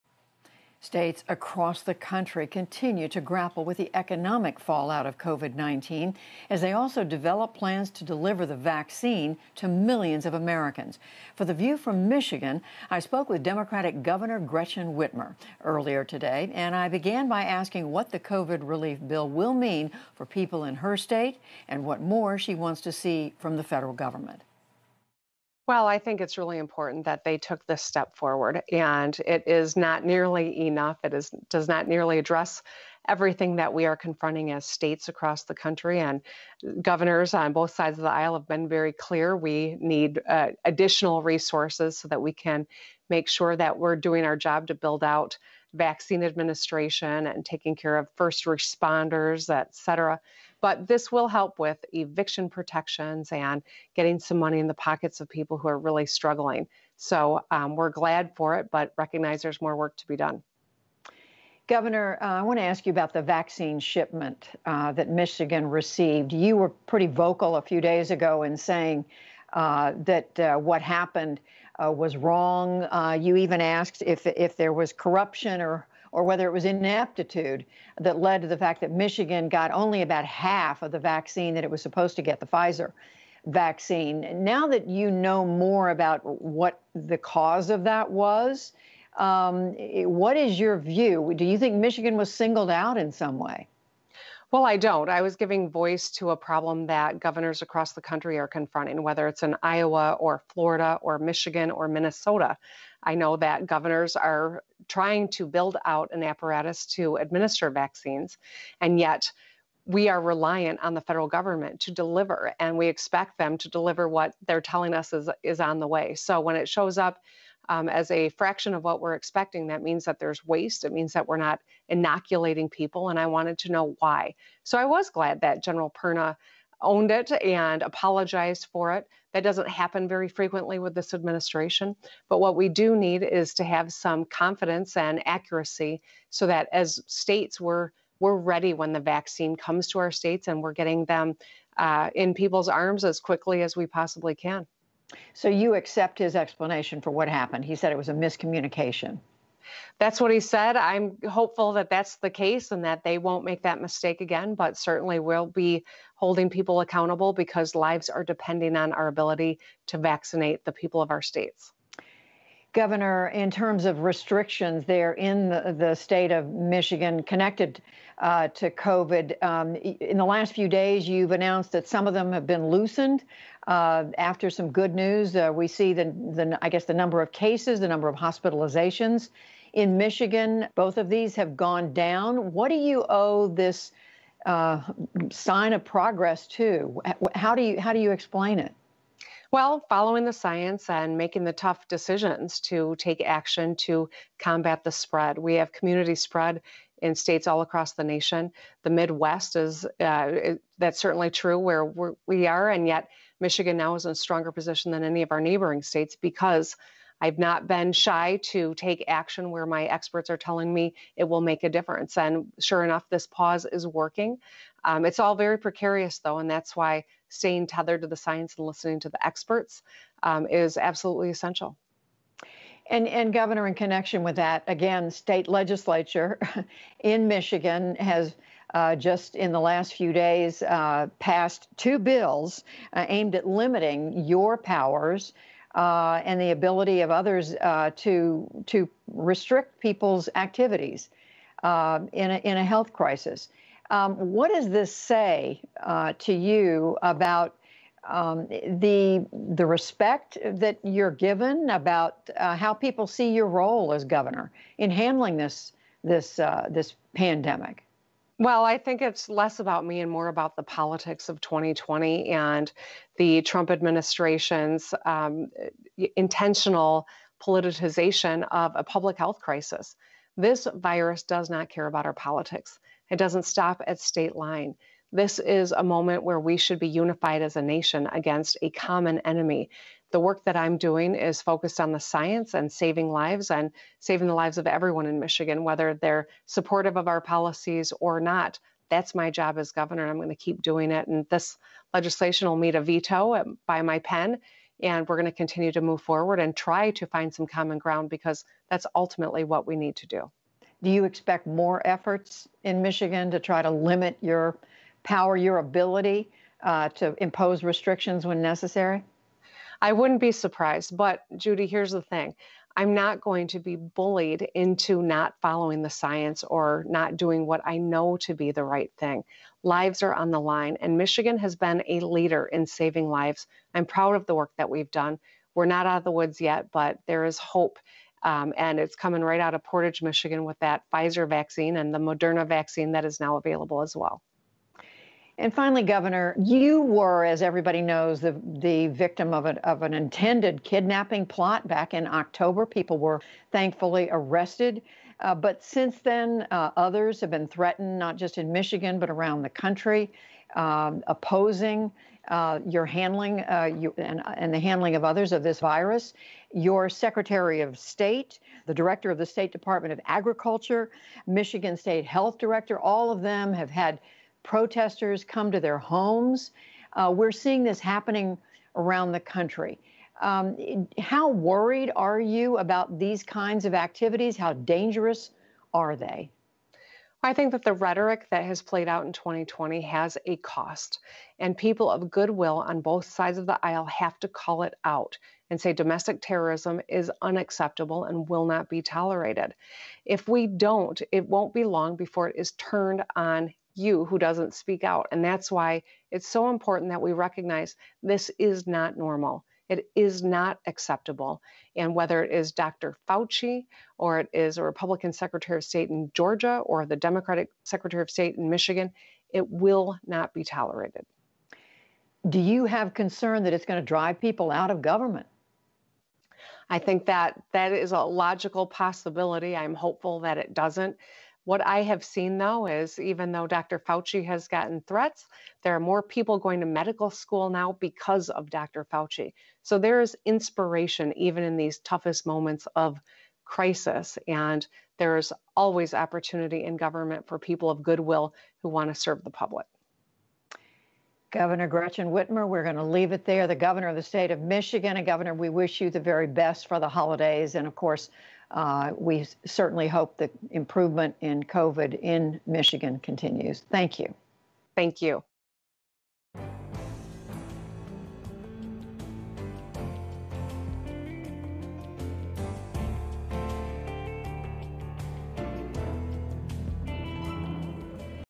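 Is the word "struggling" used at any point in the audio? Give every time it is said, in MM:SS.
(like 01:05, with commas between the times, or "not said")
00:56.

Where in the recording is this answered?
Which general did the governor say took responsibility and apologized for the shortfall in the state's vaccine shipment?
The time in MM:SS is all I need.
02:05.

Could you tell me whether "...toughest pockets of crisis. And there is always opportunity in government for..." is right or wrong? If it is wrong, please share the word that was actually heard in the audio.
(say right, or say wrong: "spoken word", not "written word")
wrong: "moments", not "pockets".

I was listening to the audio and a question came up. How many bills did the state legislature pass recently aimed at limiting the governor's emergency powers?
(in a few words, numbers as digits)
2.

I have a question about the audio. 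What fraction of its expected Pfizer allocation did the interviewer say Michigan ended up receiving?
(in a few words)
About half.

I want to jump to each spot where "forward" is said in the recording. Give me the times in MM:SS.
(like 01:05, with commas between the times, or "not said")
00:28, 04:56.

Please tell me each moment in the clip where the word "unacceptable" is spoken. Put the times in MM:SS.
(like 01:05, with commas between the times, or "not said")
06:27.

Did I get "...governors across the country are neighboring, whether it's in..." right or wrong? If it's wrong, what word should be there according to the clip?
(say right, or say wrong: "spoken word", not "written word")
wrong: "confronting", not "neighboring".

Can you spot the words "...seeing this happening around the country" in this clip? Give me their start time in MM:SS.
06:07.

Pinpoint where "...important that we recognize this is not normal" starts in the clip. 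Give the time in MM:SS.
06:36.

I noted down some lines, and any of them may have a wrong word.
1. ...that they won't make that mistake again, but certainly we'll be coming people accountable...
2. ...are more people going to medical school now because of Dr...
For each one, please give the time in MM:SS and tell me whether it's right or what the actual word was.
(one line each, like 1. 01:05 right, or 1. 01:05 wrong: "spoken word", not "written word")
1. 02:32 wrong: "holding", not "coming"
2. 07:05 right.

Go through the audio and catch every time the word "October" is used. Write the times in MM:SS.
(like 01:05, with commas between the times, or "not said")
05:42.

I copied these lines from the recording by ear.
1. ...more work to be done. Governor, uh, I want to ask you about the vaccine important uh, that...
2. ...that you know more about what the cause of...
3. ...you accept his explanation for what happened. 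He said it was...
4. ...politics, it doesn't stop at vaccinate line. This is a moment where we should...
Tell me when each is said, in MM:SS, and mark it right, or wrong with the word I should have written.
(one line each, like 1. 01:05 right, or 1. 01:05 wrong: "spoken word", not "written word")
1. 00:59 wrong: "shipment", not "important"
2. 01:24 right
3. 02:25 right
4. 04:32 wrong: "state", not "vaccinate".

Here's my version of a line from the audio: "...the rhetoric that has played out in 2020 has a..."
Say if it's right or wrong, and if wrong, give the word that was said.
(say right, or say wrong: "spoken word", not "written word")
right.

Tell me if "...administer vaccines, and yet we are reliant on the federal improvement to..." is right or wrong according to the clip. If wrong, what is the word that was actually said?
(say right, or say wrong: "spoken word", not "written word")
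wrong: "government", not "improvement".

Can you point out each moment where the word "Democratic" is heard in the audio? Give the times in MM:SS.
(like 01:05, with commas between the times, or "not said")
00:13, 06:46.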